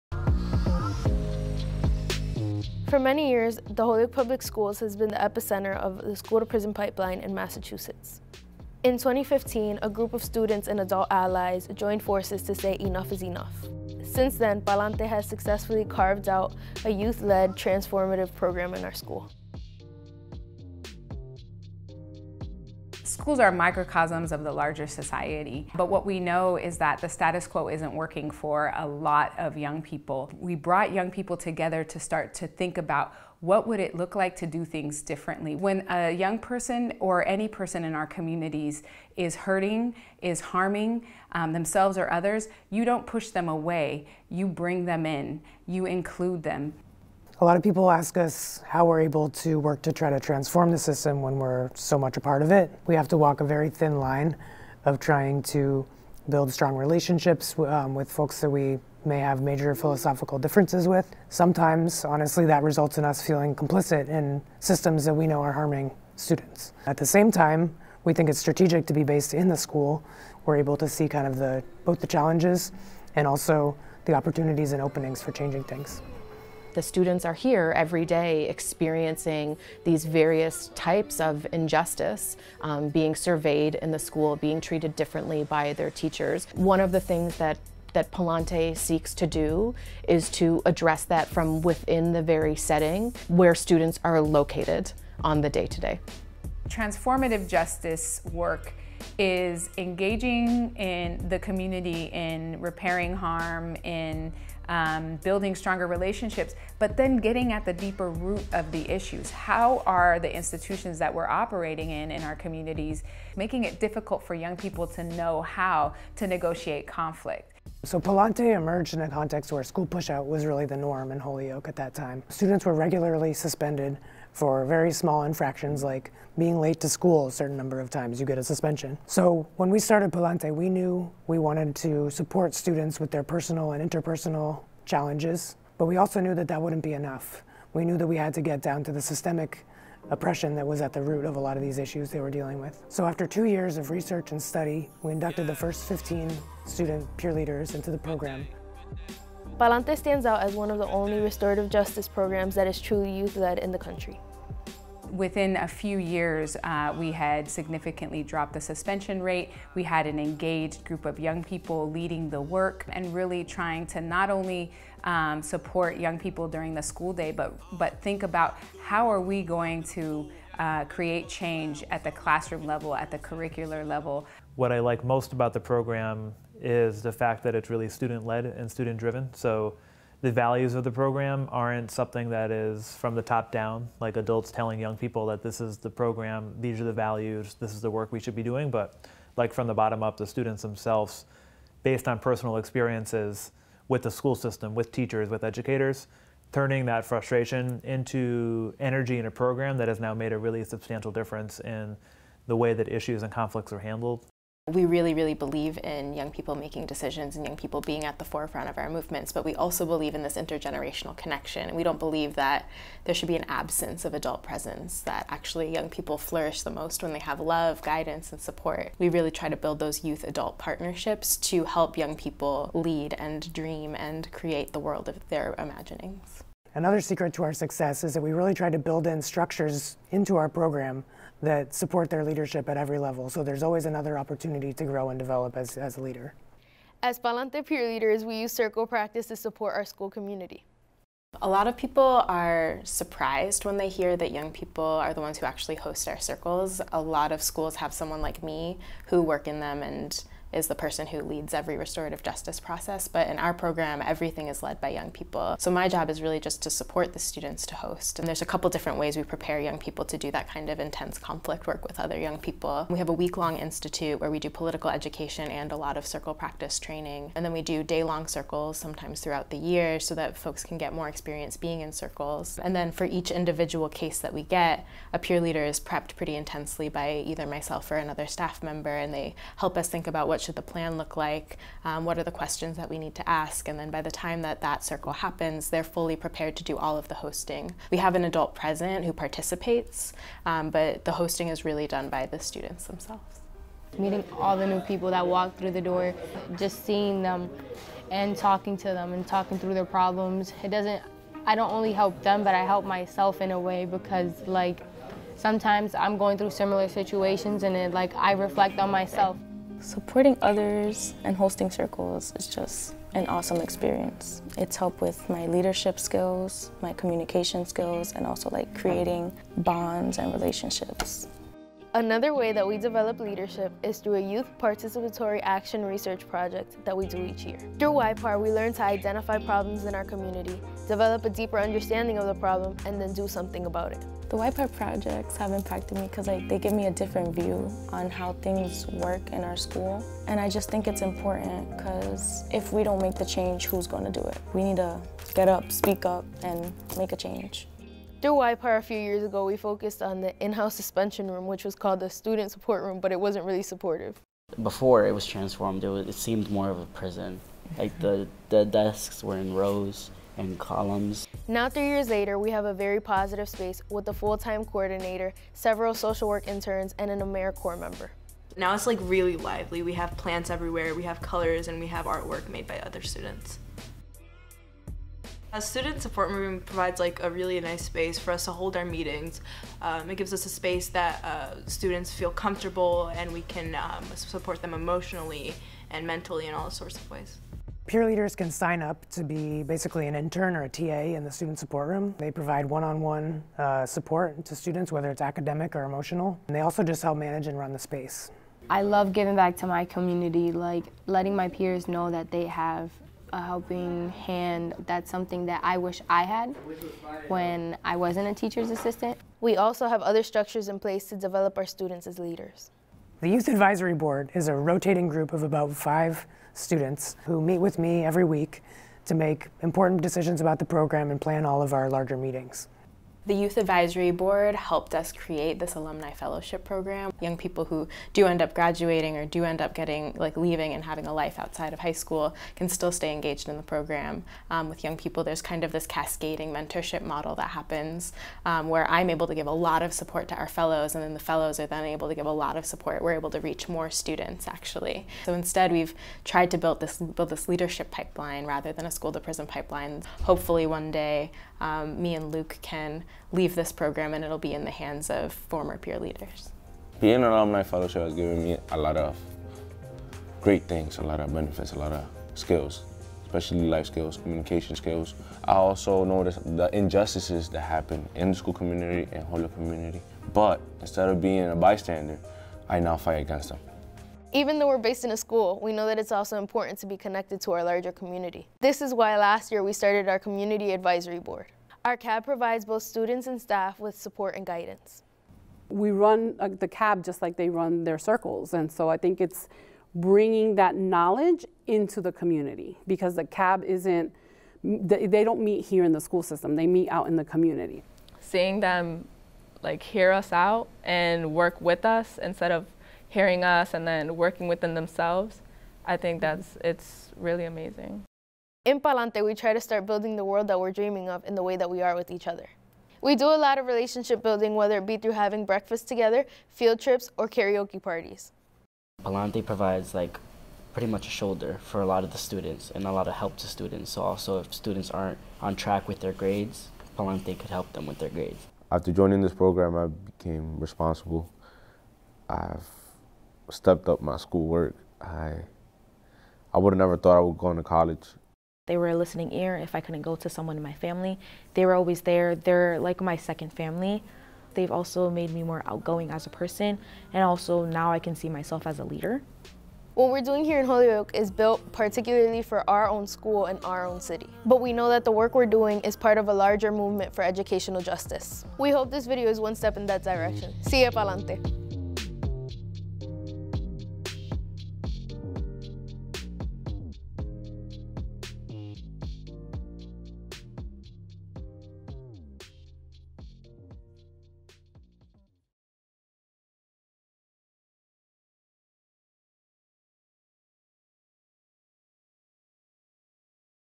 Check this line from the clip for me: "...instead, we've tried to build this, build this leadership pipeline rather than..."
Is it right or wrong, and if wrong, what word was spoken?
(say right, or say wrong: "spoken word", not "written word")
right.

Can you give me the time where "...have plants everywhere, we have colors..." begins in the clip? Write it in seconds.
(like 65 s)
369 s.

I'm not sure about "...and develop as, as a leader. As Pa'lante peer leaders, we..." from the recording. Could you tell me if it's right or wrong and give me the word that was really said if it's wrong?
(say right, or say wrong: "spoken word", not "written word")
right.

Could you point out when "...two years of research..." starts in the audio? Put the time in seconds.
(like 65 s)
143 s.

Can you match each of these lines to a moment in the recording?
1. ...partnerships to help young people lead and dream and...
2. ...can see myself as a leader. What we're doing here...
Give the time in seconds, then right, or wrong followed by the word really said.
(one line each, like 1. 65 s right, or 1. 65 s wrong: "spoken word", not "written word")
1. 220 s right
2. 547 s right.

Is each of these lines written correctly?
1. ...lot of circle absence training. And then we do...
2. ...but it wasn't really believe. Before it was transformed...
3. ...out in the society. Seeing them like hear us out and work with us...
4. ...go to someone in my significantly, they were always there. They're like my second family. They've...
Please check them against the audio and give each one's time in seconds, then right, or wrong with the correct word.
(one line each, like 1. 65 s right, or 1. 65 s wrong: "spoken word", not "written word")
1. 265 s wrong: "practice", not "absence"
2. 352 s wrong: "supportive", not "believe"
3. 496 s wrong: "community", not "society"
4. 540 s wrong: "family", not "significantly".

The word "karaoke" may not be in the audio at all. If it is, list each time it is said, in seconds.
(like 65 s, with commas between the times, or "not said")
517 s.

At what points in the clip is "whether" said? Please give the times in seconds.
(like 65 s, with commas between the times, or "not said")
394 s, 514 s.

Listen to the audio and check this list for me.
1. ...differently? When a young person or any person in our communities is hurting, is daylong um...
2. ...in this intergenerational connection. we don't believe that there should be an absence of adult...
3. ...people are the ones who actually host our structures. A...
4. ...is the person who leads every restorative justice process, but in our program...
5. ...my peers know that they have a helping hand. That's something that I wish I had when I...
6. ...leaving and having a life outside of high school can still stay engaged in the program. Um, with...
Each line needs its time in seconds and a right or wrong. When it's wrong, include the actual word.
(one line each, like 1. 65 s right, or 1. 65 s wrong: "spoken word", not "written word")
1. 35 s wrong: "harming", not "daylong"
2. 210 s right
3. 244 s wrong: "circles", not "structures"
4. 250 s right
5. 401 s right
6. 430 s right.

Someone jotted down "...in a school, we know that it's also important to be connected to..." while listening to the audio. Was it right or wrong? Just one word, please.
right.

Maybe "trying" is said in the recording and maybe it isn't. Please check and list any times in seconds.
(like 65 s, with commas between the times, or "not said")
54 s, 163 s.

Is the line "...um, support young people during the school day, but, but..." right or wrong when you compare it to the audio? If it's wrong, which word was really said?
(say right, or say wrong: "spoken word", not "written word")
right.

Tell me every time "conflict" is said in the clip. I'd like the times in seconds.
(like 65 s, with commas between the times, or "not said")
116 s, 203 s, 261 s.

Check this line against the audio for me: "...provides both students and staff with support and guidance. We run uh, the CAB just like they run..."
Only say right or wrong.
right.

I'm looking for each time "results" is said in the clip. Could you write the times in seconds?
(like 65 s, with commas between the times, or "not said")
62 s.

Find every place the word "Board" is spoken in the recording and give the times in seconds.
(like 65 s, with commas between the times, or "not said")
413 s, 424 s, 481 s.